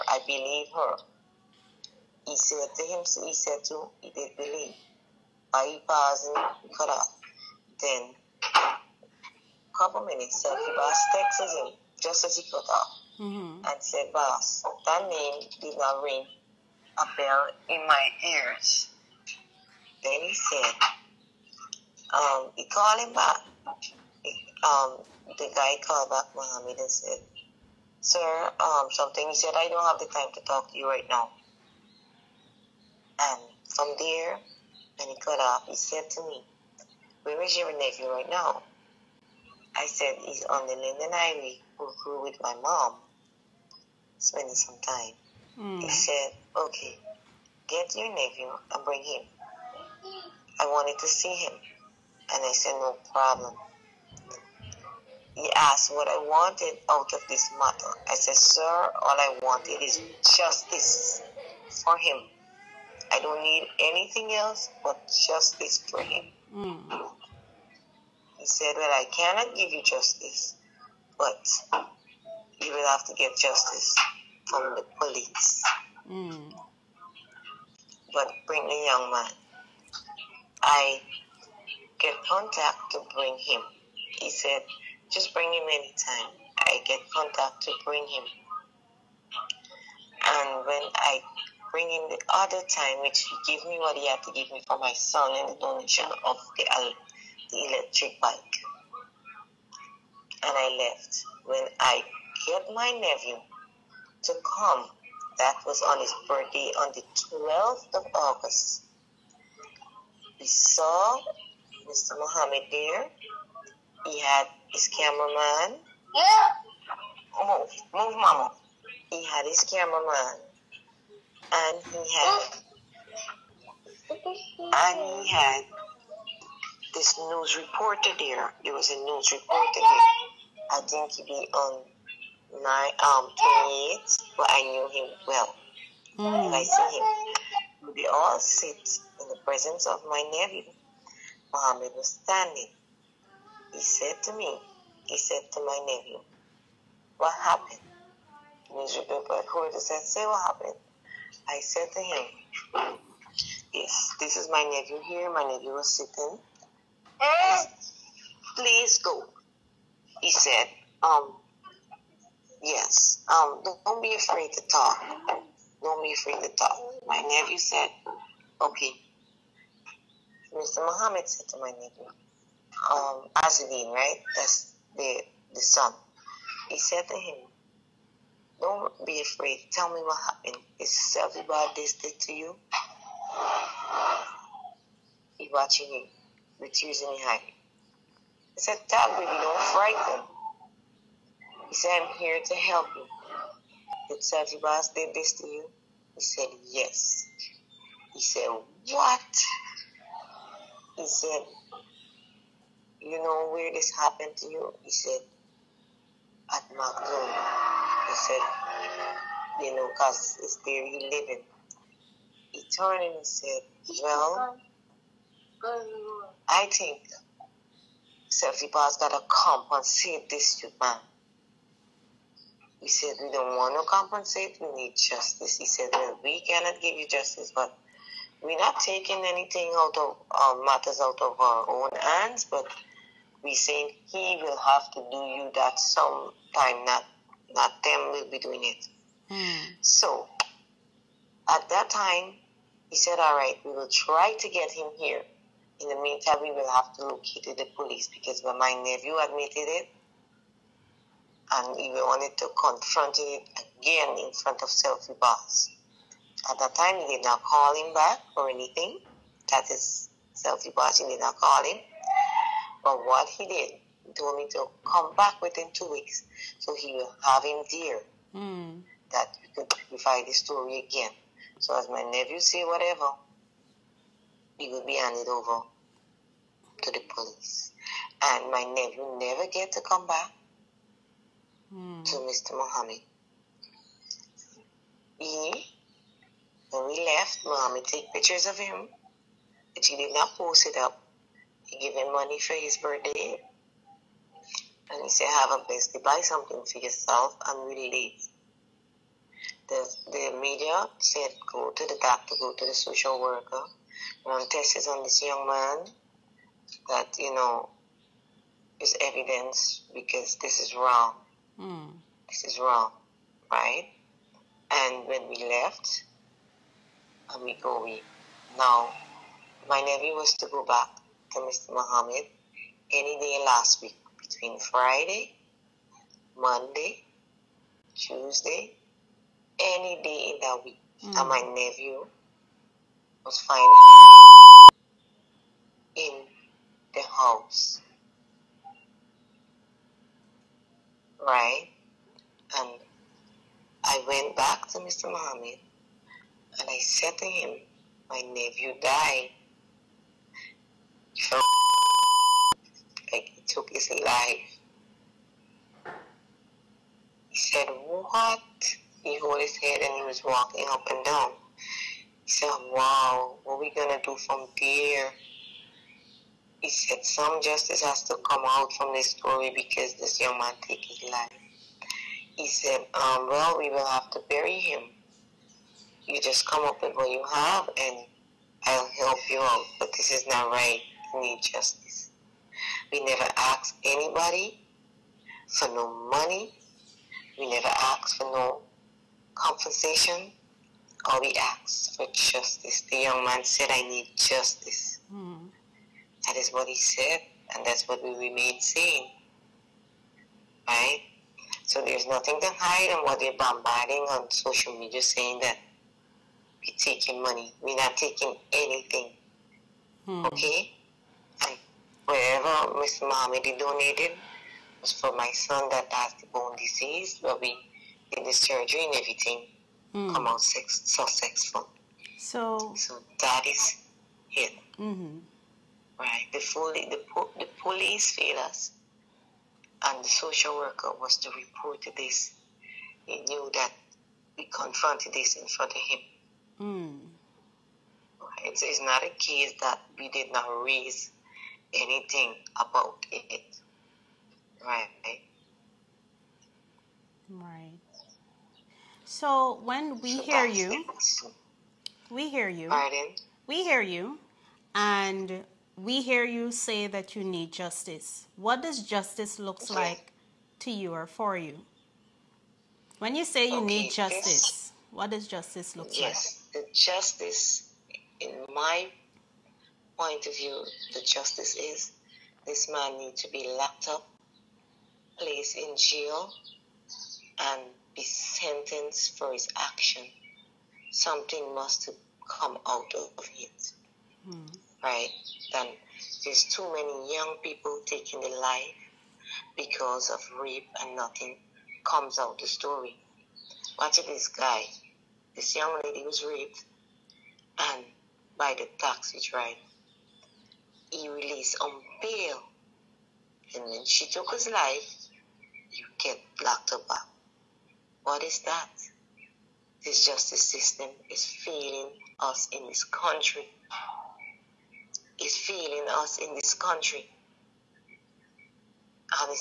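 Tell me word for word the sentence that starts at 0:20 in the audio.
Then he said, um, he called him back.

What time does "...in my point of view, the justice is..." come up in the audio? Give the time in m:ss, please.
7:48.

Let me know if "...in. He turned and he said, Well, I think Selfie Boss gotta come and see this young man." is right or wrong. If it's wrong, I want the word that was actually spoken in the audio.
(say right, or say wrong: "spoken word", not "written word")
right.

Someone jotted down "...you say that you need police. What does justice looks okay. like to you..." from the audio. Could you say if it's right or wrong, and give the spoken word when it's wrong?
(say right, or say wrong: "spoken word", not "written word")
wrong: "justice", not "police".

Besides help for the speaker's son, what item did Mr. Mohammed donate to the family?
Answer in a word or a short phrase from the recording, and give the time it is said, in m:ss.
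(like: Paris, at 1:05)
Electric bike, at 1:37.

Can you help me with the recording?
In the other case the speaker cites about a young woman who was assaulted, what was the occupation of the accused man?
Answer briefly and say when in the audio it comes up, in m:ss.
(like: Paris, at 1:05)
Taxi driver, at 8:18.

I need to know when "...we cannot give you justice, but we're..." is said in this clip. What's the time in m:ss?
3:46.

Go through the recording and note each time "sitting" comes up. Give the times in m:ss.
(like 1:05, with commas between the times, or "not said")
2:35.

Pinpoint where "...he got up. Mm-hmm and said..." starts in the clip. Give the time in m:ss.
0:12.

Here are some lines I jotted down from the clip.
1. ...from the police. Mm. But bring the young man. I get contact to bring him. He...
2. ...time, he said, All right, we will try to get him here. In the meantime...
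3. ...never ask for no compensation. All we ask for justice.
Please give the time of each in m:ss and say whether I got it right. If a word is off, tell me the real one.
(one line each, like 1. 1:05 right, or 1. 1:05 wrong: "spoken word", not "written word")
1. 1:14 right
2. 4:01 right
3. 6:27 right.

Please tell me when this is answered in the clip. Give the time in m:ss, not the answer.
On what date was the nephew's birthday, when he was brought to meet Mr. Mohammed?
1:47.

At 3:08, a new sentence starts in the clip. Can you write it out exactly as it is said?
He said, Dad, baby, don't frighten.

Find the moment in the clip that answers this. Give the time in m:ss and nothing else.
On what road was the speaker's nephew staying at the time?
0:40.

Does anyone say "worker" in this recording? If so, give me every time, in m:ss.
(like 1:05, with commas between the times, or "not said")
5:03, 7:10.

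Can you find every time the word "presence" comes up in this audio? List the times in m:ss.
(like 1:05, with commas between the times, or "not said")
2:19.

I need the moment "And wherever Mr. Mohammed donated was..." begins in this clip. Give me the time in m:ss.
6:51.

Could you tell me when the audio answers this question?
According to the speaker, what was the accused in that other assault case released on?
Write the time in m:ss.
8:22.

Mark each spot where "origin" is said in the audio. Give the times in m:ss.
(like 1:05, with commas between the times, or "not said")
not said.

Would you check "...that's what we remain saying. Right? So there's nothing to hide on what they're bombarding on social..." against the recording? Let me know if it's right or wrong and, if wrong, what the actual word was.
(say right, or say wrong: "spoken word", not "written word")
right.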